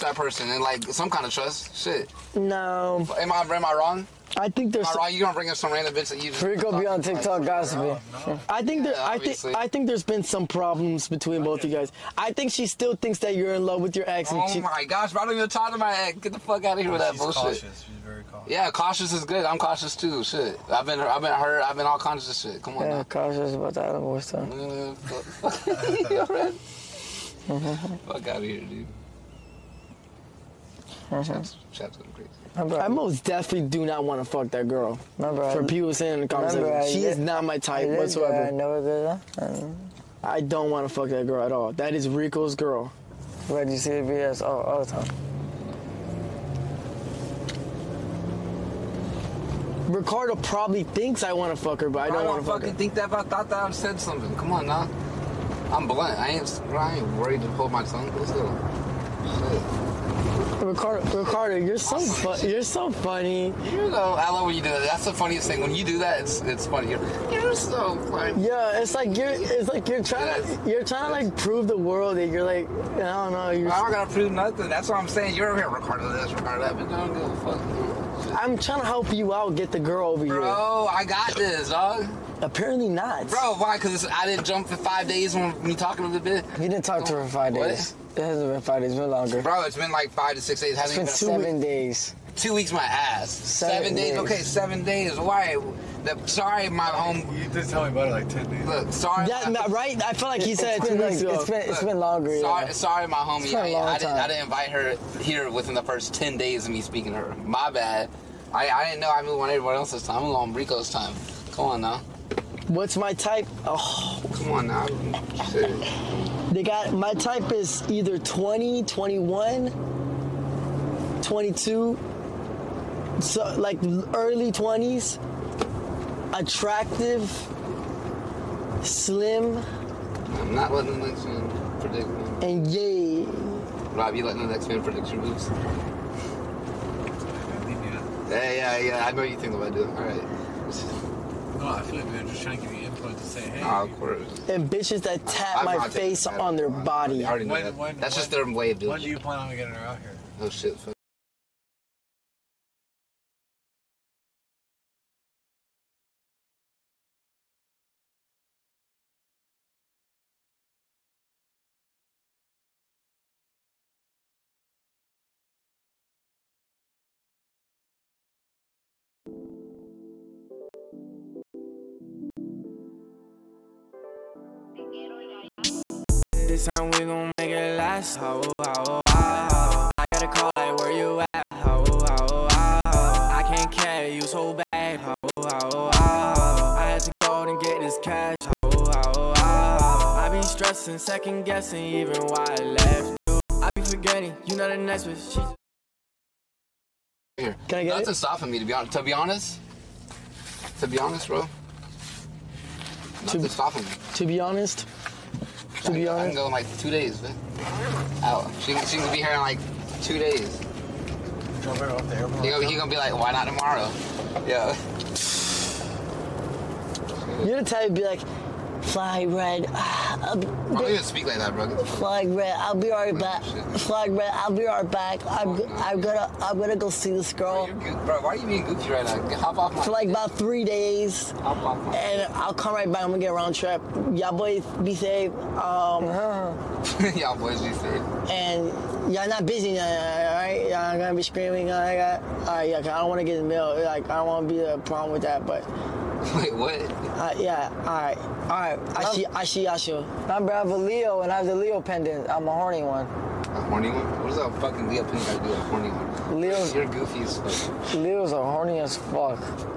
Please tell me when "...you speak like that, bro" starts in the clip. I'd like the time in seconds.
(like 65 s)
220 s.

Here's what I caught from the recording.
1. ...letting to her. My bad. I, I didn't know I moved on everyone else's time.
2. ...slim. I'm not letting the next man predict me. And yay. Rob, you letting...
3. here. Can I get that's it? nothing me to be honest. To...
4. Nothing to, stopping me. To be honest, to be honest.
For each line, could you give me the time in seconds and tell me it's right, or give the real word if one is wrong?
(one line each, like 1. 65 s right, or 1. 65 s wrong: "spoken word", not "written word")
1. 106 s wrong: "speaking", not "letting"
2. 128 s right
3. 197 s wrong: "stopping", not "nothing"
4. 203 s right.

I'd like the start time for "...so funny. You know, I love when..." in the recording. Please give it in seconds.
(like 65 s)
62 s.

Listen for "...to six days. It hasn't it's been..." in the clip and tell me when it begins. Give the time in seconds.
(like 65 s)
90 s.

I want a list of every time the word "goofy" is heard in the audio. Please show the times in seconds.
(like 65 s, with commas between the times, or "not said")
228 s, 256 s.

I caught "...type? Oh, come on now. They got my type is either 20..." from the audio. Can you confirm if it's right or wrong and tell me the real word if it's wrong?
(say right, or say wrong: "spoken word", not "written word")
right.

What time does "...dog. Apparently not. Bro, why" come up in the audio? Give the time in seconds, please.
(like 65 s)
81 s.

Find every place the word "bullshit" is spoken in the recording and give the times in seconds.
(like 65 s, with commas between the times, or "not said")
17 s.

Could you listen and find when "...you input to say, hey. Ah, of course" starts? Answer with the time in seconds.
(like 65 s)
142 s.